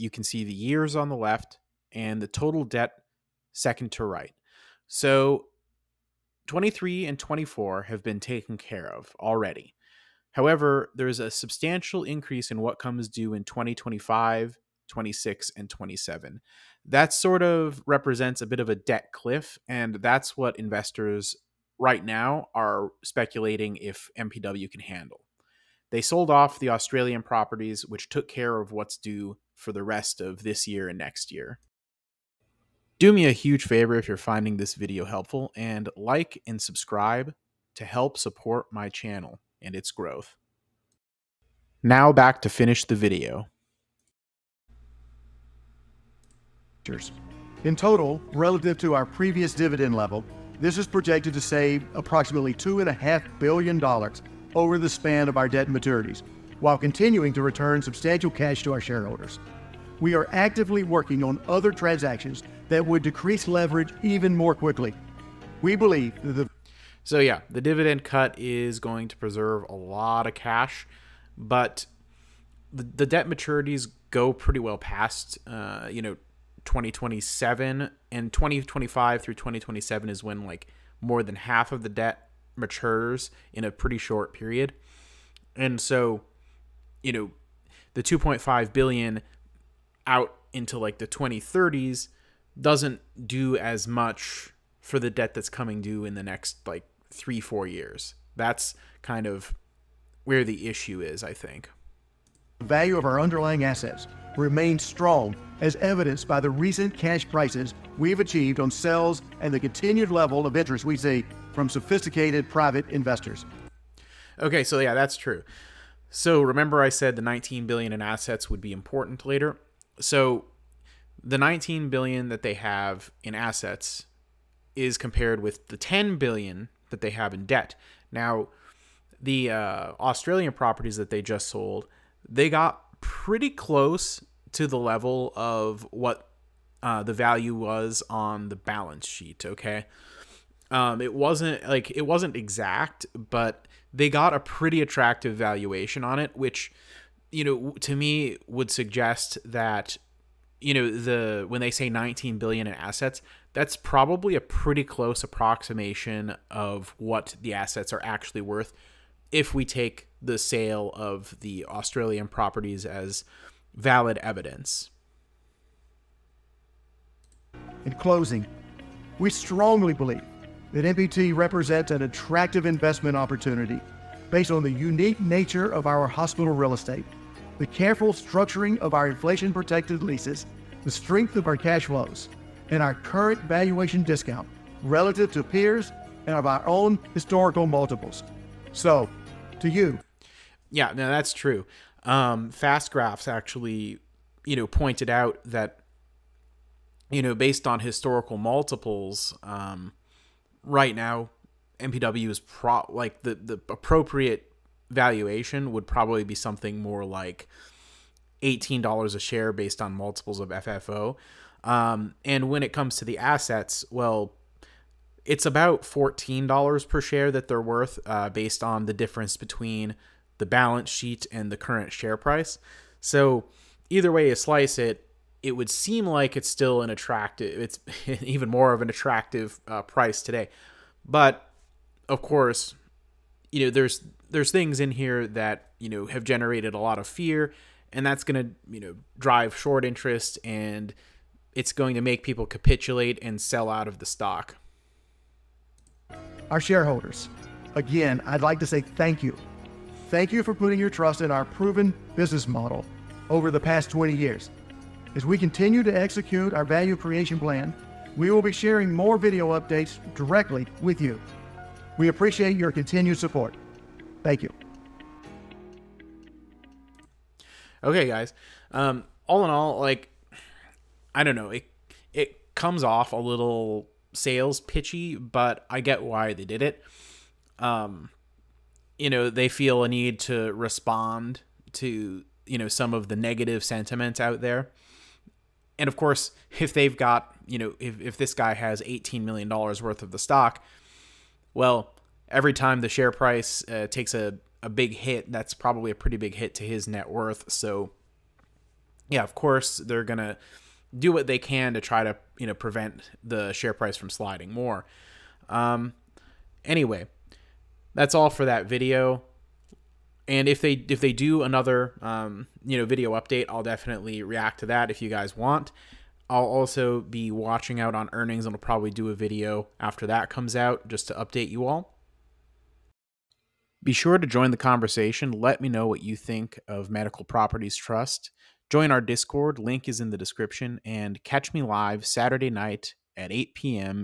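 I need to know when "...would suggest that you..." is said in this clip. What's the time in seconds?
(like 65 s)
148 s.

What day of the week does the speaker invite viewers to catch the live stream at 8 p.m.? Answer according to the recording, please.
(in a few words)
Saturday.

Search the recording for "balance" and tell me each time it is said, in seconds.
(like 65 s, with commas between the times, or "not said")
138 s, 220 s.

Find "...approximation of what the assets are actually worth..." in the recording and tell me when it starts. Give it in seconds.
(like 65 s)
155 s.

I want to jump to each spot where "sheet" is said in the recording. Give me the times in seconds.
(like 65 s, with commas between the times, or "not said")
139 s, 220 s.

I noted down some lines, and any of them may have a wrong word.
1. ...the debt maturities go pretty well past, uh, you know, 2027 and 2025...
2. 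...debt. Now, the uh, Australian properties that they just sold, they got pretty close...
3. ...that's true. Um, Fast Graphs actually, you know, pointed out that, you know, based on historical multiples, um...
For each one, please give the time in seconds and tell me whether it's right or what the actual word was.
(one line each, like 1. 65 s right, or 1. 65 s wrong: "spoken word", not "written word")
1. 72 s right
2. 127 s right
3. 191 s right.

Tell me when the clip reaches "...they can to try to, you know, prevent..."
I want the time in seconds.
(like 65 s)
301 s.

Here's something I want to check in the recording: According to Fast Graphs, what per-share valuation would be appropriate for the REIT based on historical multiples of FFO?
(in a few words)
$18 per share.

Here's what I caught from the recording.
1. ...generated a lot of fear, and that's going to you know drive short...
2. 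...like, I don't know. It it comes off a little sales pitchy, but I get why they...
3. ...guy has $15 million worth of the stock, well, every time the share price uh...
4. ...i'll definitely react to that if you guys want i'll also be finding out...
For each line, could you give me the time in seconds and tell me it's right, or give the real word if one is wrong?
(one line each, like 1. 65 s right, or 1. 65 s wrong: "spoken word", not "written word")
1. 236 s right
2. 269 s right
3. 288 s wrong: "18", not "15"
4. 313 s wrong: "watching", not "finding".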